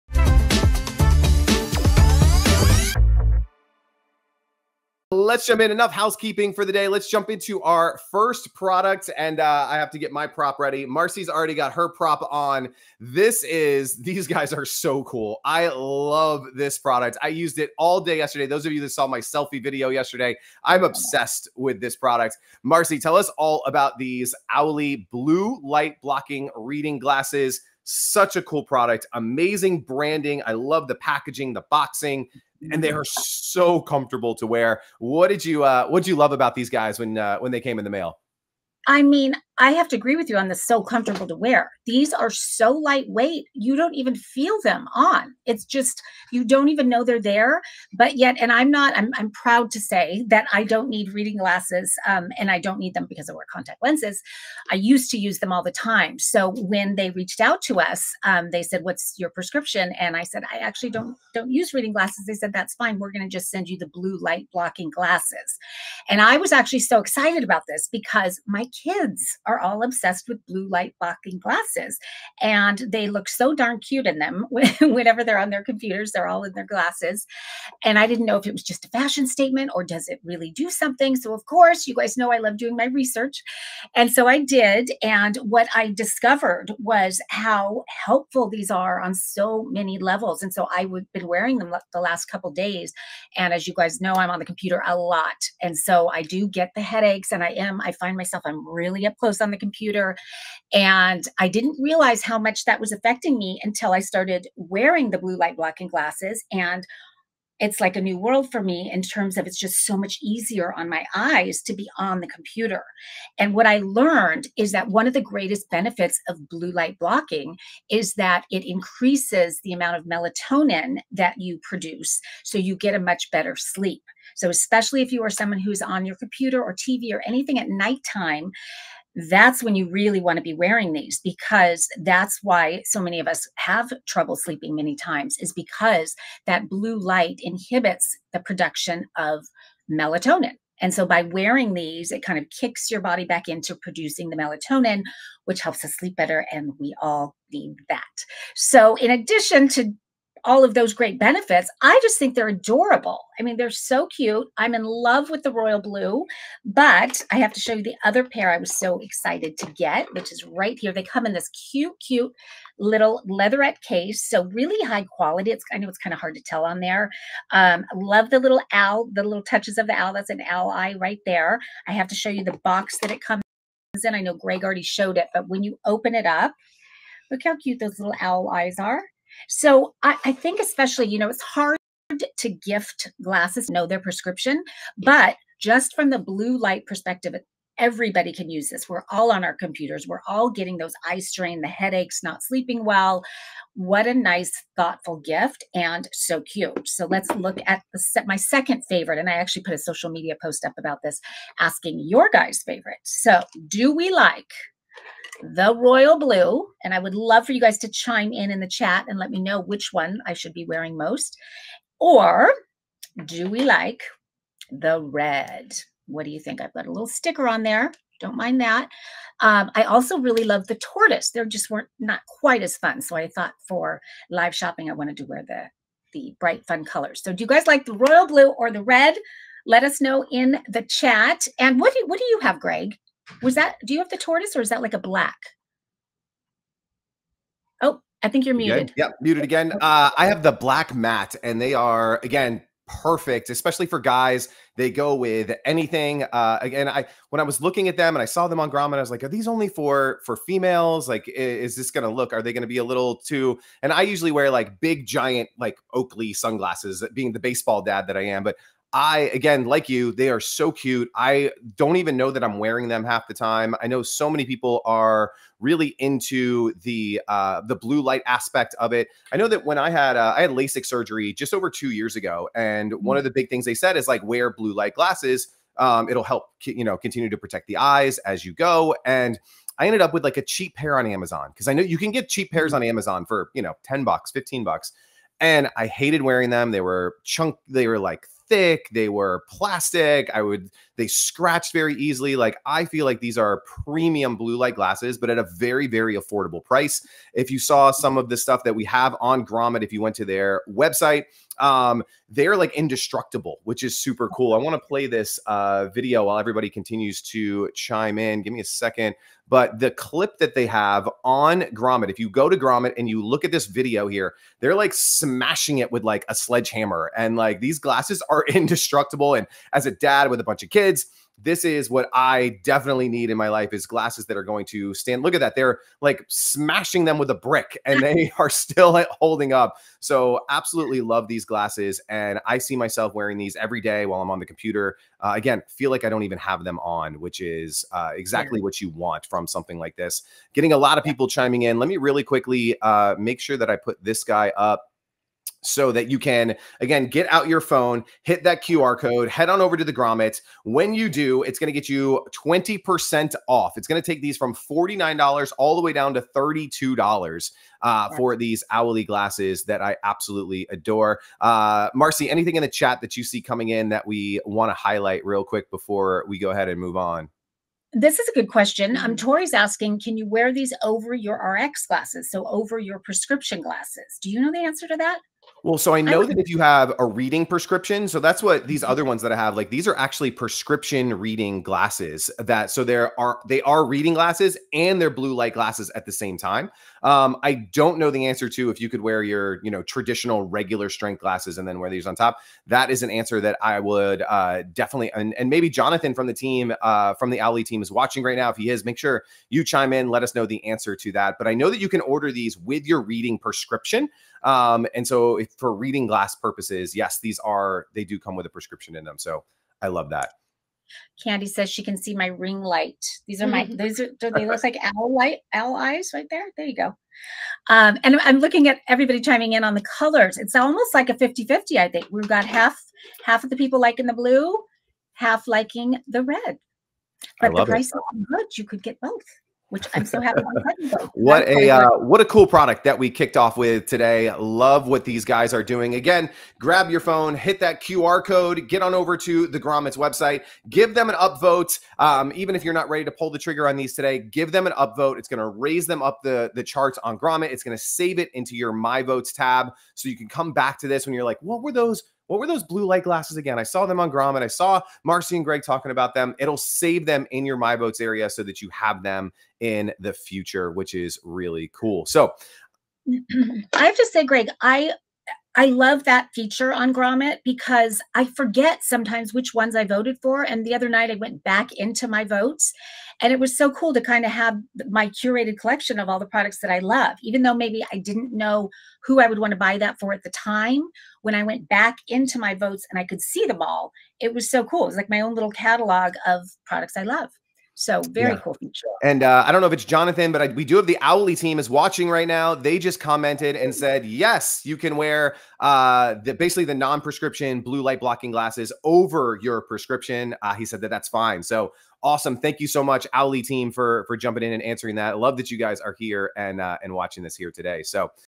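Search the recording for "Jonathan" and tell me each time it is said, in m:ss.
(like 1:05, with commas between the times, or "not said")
6:35, 8:09.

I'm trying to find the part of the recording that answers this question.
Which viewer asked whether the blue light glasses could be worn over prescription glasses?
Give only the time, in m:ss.
6:09.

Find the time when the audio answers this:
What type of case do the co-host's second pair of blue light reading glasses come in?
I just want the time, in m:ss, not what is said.
2:43.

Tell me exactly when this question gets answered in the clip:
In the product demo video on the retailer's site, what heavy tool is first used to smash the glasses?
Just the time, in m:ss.
5:16.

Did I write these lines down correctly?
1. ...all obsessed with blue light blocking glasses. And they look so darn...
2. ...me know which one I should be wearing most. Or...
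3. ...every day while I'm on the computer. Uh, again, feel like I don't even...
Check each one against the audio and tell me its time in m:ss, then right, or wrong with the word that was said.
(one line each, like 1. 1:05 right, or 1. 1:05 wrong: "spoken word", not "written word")
1. 1:09 right
2. 3:29 right
3. 5:33 right.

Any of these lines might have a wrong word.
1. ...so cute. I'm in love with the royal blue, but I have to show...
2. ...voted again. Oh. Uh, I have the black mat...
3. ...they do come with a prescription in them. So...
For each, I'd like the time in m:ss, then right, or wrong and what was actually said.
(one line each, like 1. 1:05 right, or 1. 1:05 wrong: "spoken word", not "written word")
1. 2:33 right
2. 3:59 wrong: "muted", not "voted"
3. 6:47 right.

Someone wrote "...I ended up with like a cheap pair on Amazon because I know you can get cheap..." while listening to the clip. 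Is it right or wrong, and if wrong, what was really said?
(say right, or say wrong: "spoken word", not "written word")
right.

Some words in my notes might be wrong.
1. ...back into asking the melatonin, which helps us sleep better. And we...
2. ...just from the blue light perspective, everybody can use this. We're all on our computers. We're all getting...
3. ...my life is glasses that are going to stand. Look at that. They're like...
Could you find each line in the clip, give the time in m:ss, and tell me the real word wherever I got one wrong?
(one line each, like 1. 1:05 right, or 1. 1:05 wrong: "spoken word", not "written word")
1. 2:23 wrong: "producing", not "asking"
2. 3:05 right
3. 5:23 right.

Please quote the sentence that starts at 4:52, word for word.
Like I feel like these are premium blue light glasses, but at a very very affordable price.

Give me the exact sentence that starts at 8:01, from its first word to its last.
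When I went back into my votes and I could see them all, it was so cool.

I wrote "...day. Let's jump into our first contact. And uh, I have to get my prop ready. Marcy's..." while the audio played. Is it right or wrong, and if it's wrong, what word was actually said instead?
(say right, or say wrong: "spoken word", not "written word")
wrong: "product", not "contact".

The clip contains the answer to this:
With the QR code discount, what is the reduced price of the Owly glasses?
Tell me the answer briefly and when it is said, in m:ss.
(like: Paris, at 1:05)
$32, at 5:56.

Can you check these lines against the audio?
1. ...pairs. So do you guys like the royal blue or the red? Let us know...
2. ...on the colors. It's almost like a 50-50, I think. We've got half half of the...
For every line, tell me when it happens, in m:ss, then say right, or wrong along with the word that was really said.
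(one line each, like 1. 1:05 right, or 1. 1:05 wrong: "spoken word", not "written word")
1. 3:46 wrong: "colors", not "pairs"
2. 6:59 right.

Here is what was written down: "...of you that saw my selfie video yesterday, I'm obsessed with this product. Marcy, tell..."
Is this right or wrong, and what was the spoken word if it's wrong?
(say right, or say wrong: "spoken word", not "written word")
right.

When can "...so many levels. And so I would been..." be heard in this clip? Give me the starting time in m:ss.
1:29.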